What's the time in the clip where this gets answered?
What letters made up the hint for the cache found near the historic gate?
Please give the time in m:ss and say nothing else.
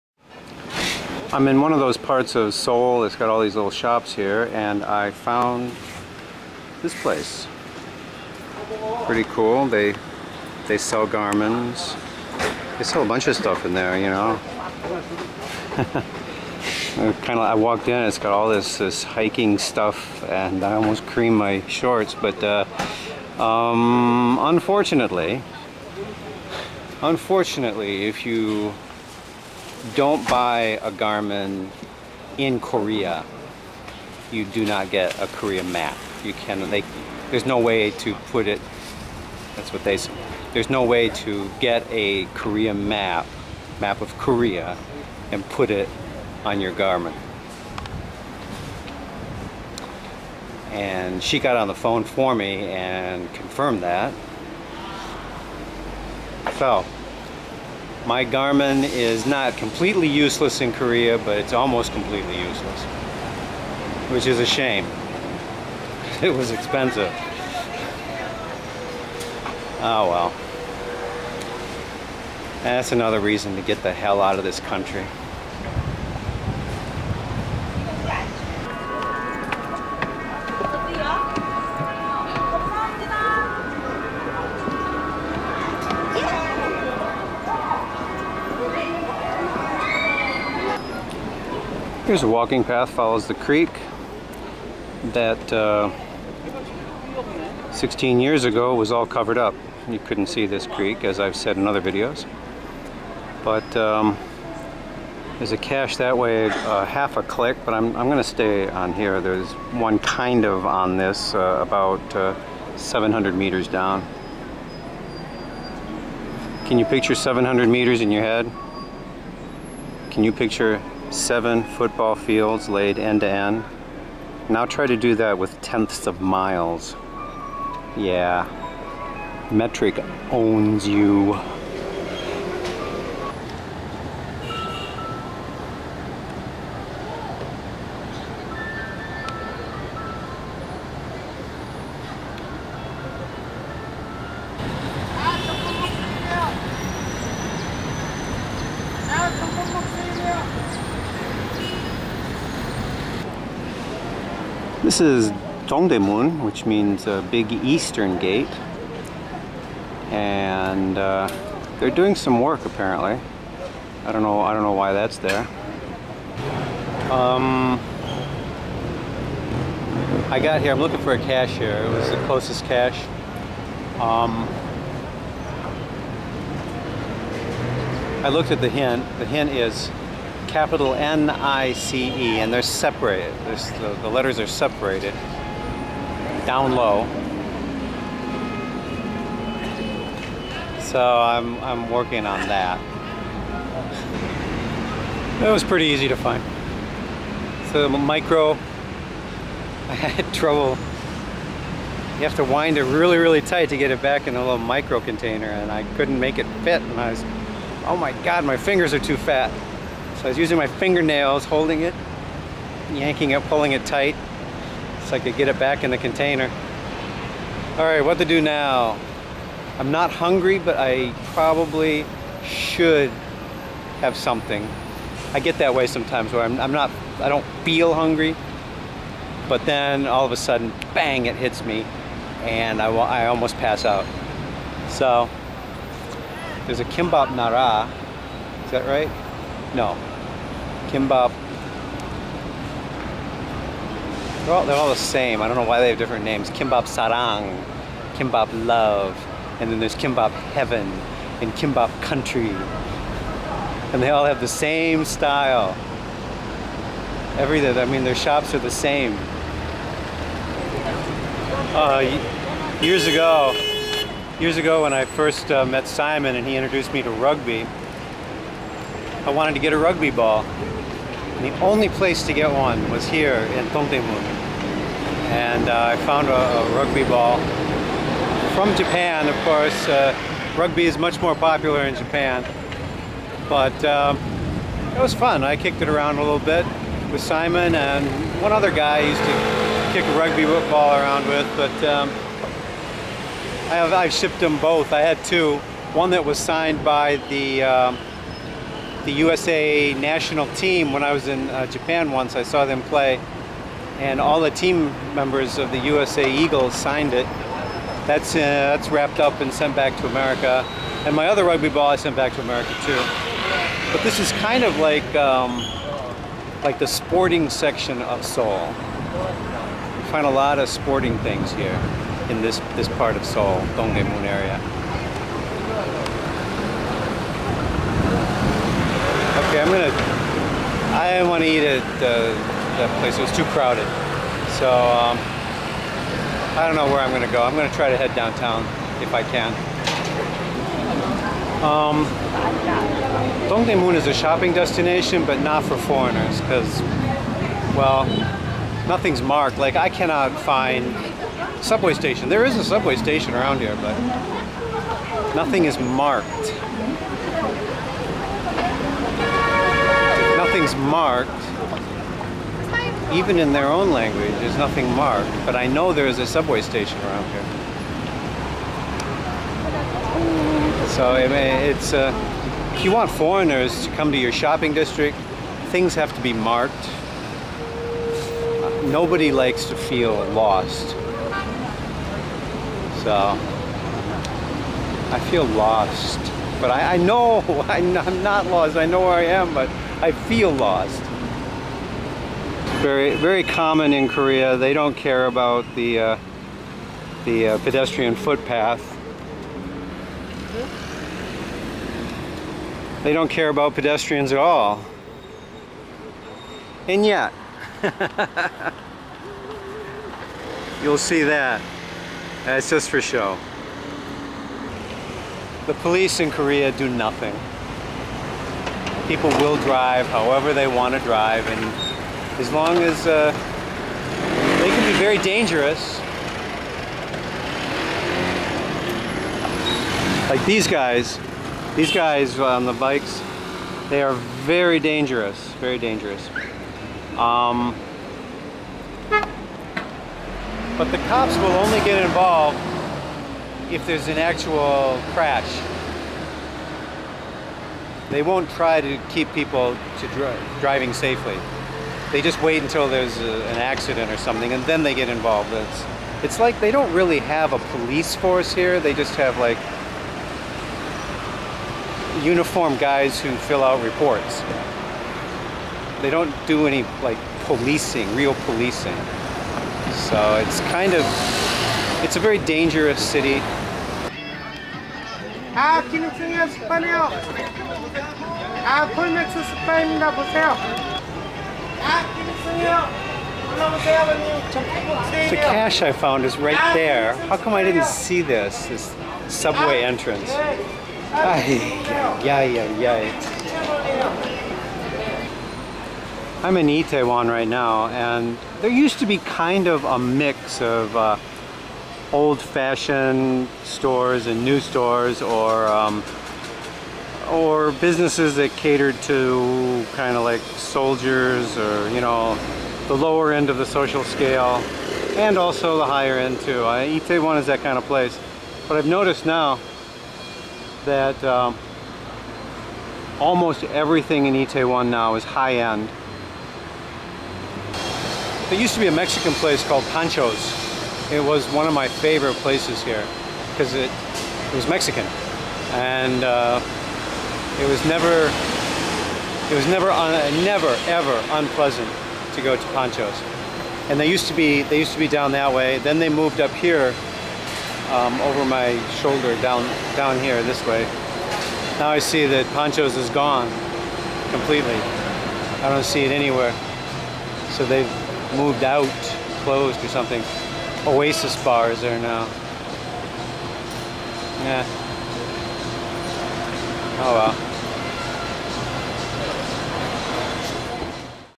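3:00.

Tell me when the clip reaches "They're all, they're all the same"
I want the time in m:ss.
4:04.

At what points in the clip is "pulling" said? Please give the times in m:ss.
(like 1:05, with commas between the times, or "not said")
3:33.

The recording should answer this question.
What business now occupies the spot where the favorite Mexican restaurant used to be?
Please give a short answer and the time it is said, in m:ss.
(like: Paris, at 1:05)
Oasis Bar, at 9:20.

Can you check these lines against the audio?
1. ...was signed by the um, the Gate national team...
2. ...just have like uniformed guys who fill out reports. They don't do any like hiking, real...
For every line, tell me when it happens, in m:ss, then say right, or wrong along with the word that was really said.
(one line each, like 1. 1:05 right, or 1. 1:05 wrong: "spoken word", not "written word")
1. 4:56 wrong: "USA", not "Gate"
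2. 7:38 wrong: "policing", not "hiking".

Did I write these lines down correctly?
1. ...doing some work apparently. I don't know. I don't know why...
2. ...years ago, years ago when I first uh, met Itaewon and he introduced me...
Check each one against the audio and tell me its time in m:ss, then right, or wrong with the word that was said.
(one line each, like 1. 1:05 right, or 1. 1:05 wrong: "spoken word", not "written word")
1. 2:41 right
2. 4:22 wrong: "Simon", not "Itaewon".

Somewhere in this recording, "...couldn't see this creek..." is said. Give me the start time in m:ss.
1:39.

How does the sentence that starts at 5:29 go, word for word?
Okay, I'm gonna, I didn't want to eat at uh, that place, it was too crowded.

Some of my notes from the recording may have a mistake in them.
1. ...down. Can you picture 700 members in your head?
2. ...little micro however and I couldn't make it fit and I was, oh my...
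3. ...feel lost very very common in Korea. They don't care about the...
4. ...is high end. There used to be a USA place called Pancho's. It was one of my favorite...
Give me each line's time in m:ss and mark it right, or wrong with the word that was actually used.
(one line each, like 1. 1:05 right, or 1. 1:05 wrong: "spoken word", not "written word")
1. 1:53 wrong: "meters", not "members"
2. 3:24 wrong: "container", not "however"
3. 6:30 right
4. 8:45 wrong: "Mexican", not "USA".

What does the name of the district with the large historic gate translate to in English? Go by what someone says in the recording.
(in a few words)
Big Eastern Gate.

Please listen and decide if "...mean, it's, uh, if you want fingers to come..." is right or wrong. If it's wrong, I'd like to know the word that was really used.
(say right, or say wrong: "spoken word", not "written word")
wrong: "foreigners", not "fingers".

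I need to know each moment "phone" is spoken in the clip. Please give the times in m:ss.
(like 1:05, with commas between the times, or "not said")
0:51.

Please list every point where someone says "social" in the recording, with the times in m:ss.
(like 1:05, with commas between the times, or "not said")
8:33.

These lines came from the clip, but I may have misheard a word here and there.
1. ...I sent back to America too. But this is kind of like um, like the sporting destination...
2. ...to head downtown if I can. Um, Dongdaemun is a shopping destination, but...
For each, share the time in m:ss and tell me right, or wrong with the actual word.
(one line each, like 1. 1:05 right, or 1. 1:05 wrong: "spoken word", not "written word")
1. 5:11 wrong: "section", not "destination"
2. 5:37 right.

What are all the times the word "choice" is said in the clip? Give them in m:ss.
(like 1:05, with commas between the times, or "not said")
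not said.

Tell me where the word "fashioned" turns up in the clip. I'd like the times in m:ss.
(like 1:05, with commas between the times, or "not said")
8:22.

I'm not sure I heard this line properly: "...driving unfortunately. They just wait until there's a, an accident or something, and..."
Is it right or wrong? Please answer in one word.
wrong.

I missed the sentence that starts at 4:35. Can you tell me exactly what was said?
And uh, I found a, a, rugby ball from Japan, of course.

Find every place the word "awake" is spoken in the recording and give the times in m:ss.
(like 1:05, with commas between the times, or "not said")
not said.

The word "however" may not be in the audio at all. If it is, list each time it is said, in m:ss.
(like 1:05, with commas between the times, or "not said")
7:00.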